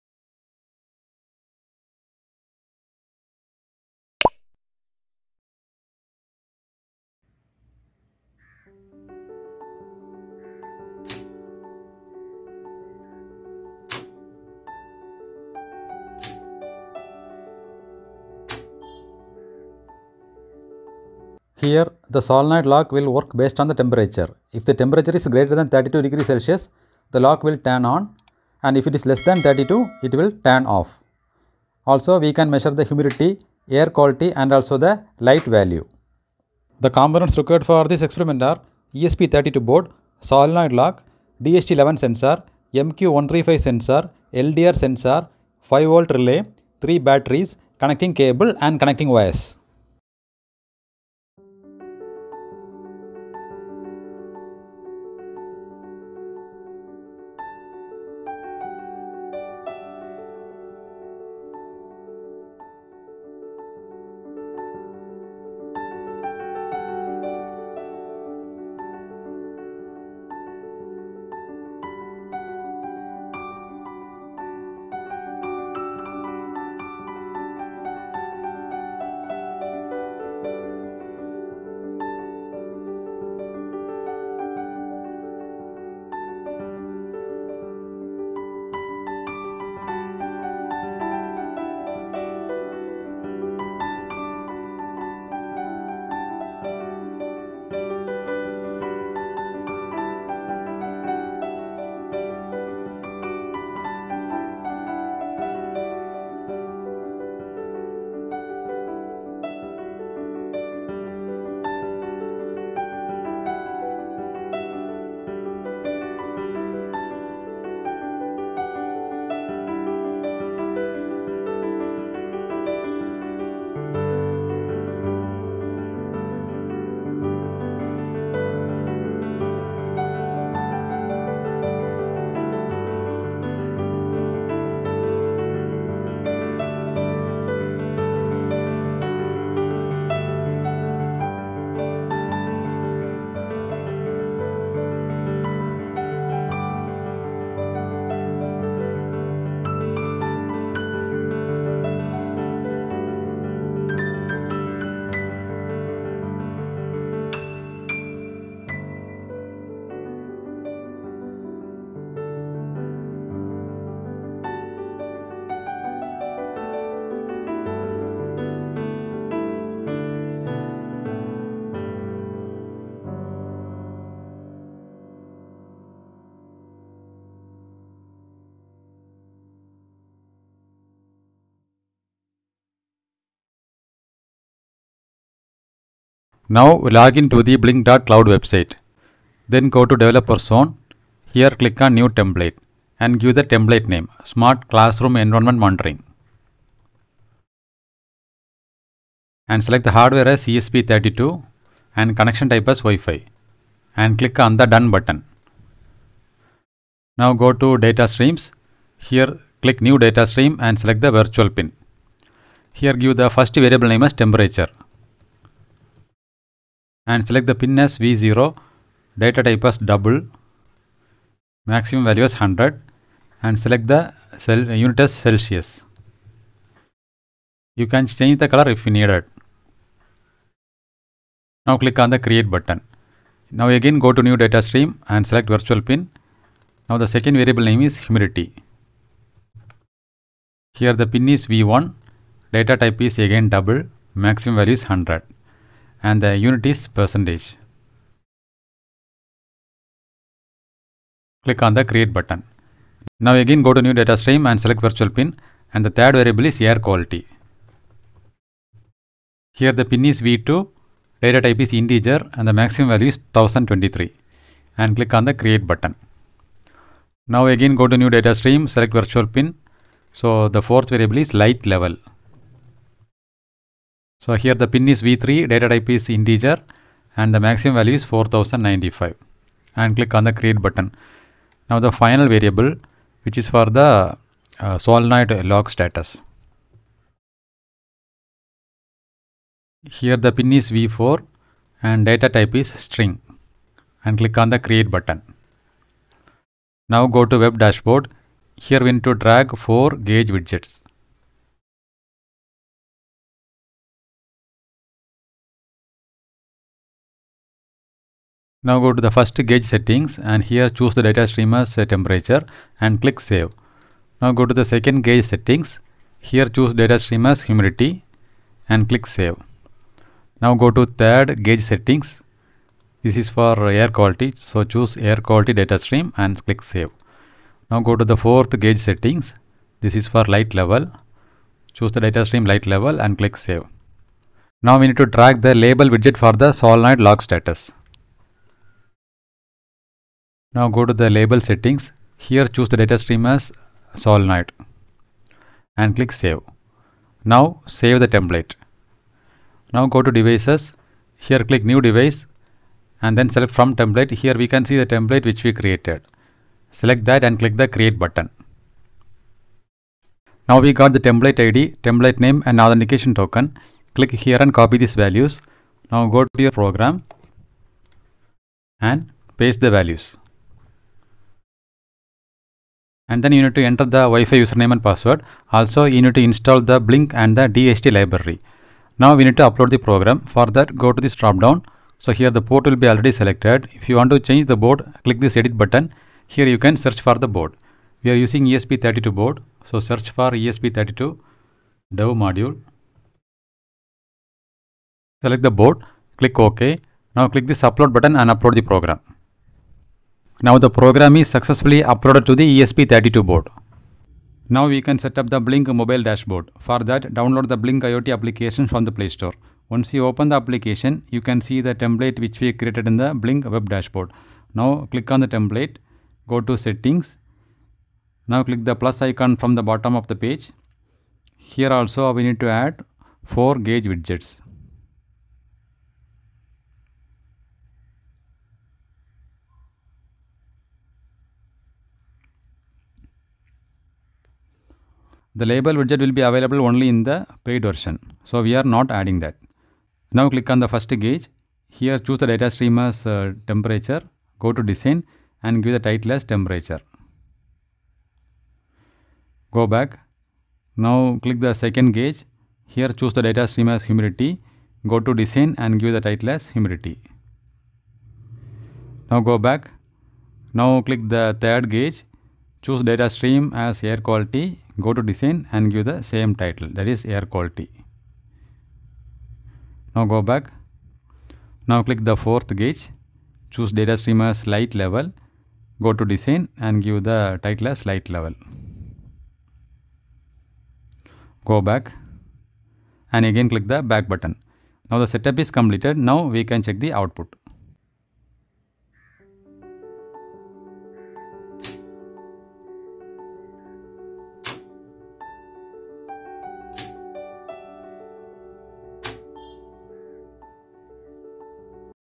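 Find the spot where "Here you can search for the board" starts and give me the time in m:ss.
6:26.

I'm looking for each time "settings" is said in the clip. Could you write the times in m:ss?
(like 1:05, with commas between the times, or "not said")
5:09, 5:15, 5:21, 5:28, 5:41, 6:56.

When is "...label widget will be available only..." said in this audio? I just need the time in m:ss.
7:15.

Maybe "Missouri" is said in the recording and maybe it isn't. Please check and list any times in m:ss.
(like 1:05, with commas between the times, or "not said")
not said.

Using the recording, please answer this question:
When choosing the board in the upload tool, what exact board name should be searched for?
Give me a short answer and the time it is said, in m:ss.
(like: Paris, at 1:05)
ESP32 dev module, at 6:30.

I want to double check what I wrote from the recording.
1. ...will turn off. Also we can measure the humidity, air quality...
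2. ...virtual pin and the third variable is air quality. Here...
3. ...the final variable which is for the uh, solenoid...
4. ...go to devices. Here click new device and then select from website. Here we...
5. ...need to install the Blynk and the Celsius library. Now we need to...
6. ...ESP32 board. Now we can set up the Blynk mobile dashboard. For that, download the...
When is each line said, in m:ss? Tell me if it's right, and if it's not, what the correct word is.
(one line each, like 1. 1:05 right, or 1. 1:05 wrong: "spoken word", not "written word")
1. 0:30 right
2. 4:14 right
3. 4:41 right
4. 5:49 wrong: "template", not "website"
5. 6:16 wrong: "DHT", not "Celsius"
6. 6:42 right.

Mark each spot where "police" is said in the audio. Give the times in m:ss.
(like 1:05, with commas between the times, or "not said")
not said.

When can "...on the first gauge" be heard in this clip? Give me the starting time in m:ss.
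7:20.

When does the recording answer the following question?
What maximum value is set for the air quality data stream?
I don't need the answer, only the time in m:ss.
4:23.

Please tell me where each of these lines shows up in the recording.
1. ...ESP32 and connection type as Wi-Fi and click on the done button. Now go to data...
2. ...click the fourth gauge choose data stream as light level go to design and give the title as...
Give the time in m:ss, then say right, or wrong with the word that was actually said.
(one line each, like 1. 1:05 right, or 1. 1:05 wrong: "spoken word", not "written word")
1. 3:20 right
2. 7:51 right.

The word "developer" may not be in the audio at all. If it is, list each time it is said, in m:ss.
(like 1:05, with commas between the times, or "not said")
3:09.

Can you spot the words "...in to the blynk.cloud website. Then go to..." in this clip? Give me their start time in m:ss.
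3:07.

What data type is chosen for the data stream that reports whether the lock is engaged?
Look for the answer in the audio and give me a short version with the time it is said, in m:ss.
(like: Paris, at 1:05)
string, at 4:52.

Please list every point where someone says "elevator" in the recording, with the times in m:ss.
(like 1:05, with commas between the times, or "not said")
not said.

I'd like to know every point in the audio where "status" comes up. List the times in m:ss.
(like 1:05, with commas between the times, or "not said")
4:45, 5:37.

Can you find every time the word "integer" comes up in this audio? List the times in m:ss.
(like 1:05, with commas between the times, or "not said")
4:21, 4:36.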